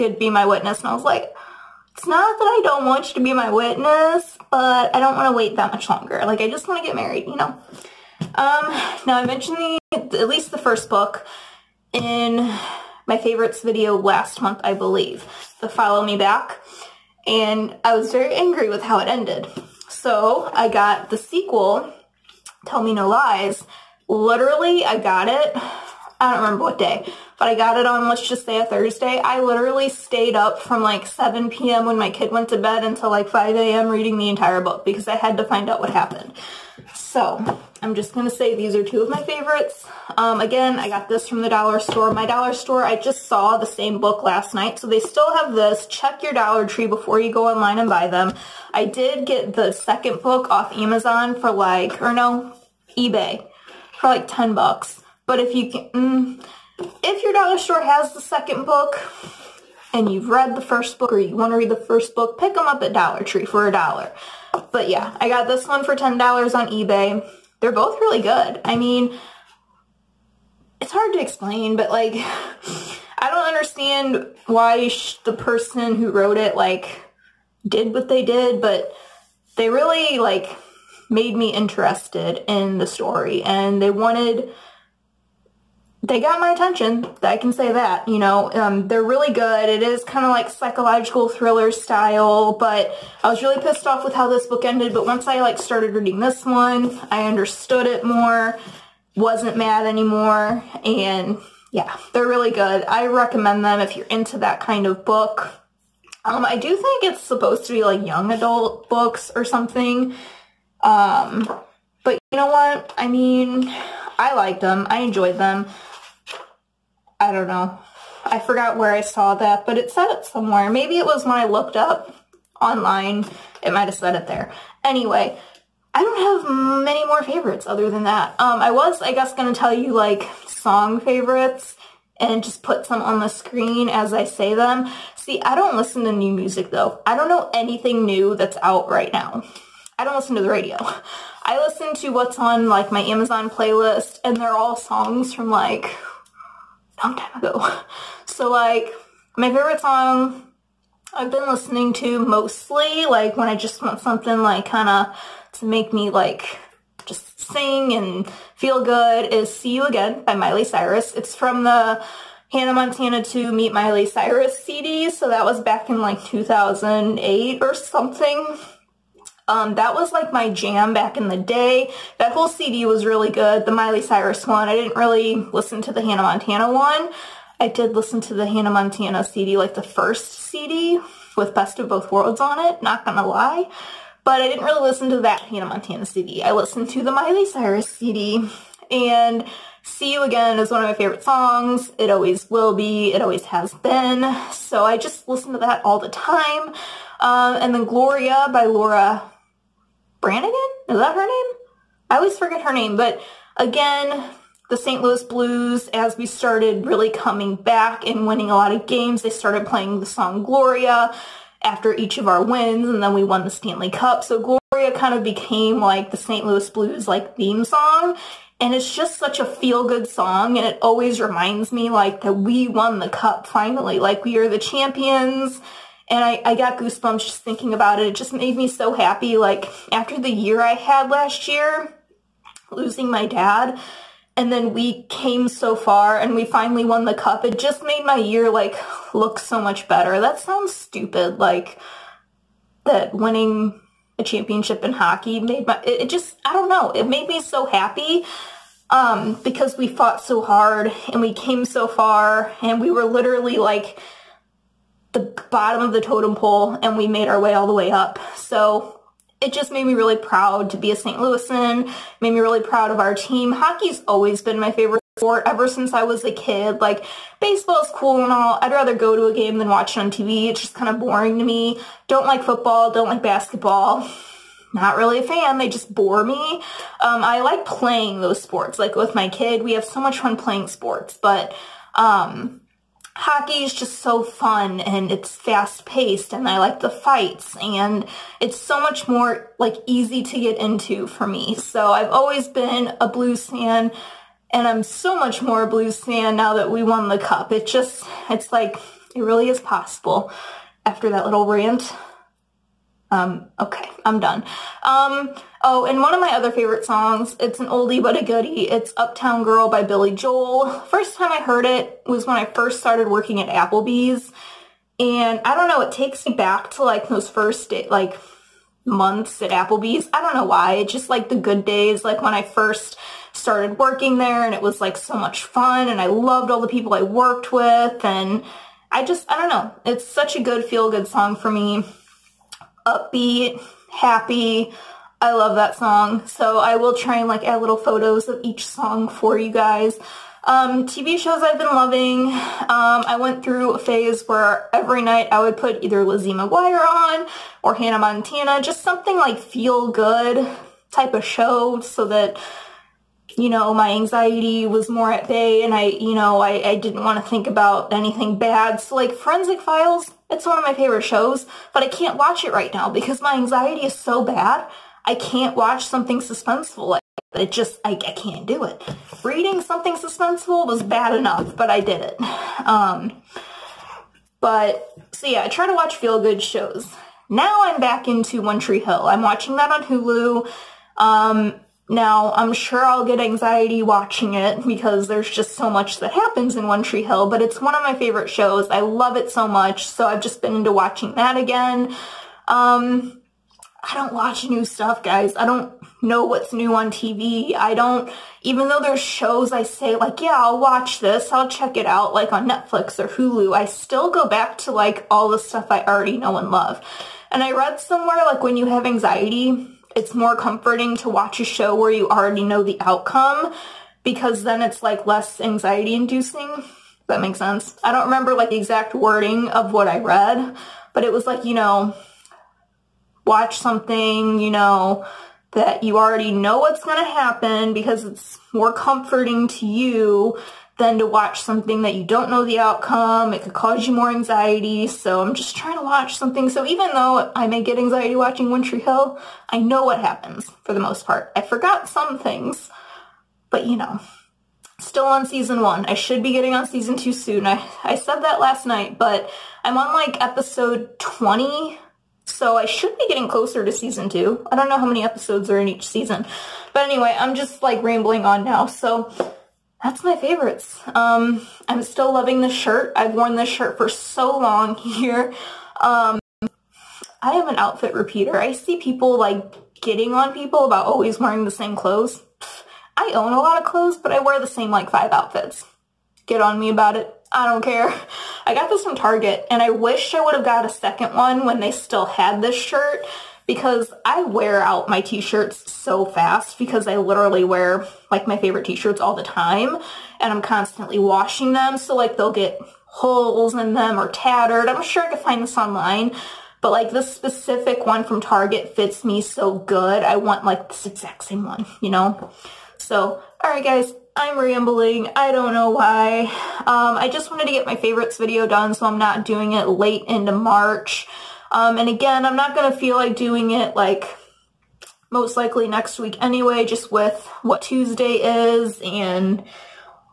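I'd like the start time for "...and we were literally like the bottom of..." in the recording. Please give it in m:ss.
4:12.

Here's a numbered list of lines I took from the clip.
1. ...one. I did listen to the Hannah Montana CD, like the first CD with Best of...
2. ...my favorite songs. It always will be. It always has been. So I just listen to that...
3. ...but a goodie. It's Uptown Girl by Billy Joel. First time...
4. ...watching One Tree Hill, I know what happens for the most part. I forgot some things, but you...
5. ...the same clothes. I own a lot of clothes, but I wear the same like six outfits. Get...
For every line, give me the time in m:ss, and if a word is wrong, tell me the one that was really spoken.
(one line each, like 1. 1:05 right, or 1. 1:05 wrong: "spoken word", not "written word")
1. 2:56 right
2. 3:10 right
3. 5:08 right
4. 7:18 right
5. 7:51 wrong: "five", not "six".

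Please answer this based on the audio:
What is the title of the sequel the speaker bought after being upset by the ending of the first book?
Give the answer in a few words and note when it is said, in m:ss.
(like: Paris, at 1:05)
Tell Me No Lies, at 0:22.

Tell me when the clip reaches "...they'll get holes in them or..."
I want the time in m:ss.
8:12.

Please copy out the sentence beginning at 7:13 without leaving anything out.
It could cause you more anxiety.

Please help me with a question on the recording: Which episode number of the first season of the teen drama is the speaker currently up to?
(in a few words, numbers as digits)
20.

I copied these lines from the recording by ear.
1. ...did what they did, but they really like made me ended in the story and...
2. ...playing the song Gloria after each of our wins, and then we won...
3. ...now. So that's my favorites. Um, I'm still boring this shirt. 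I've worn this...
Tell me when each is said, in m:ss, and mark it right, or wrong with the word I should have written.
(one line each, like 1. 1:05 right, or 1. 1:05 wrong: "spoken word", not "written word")
1. 1:17 wrong: "interested", not "ended"
2. 3:29 right
3. 7:38 wrong: "loving", not "boring".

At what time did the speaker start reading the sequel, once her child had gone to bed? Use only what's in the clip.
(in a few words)
7 p.m.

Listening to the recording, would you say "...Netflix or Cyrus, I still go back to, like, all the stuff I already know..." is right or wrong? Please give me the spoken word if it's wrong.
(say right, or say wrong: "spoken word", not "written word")
wrong: "Hulu", not "Cyrus".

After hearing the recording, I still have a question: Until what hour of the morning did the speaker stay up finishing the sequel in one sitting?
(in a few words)
5 a.m.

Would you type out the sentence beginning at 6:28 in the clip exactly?
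I love it so much, so I've just been into watching that again.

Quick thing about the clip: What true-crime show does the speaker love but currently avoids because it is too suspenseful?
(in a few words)
Forensic Files.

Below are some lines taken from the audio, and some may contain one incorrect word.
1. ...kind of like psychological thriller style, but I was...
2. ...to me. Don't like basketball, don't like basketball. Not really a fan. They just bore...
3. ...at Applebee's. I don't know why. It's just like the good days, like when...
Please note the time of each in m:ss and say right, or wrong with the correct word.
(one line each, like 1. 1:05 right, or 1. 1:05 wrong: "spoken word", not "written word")
1. 1:30 right
2. 4:31 wrong: "football", not "basketball"
3. 5:19 right.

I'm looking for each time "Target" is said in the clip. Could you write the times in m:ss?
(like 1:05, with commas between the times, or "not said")
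7:58, 8:18.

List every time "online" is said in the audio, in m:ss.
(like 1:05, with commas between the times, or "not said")
0:47, 2:02, 8:15.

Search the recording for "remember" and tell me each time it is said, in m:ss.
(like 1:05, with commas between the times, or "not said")
0:26, 6:58.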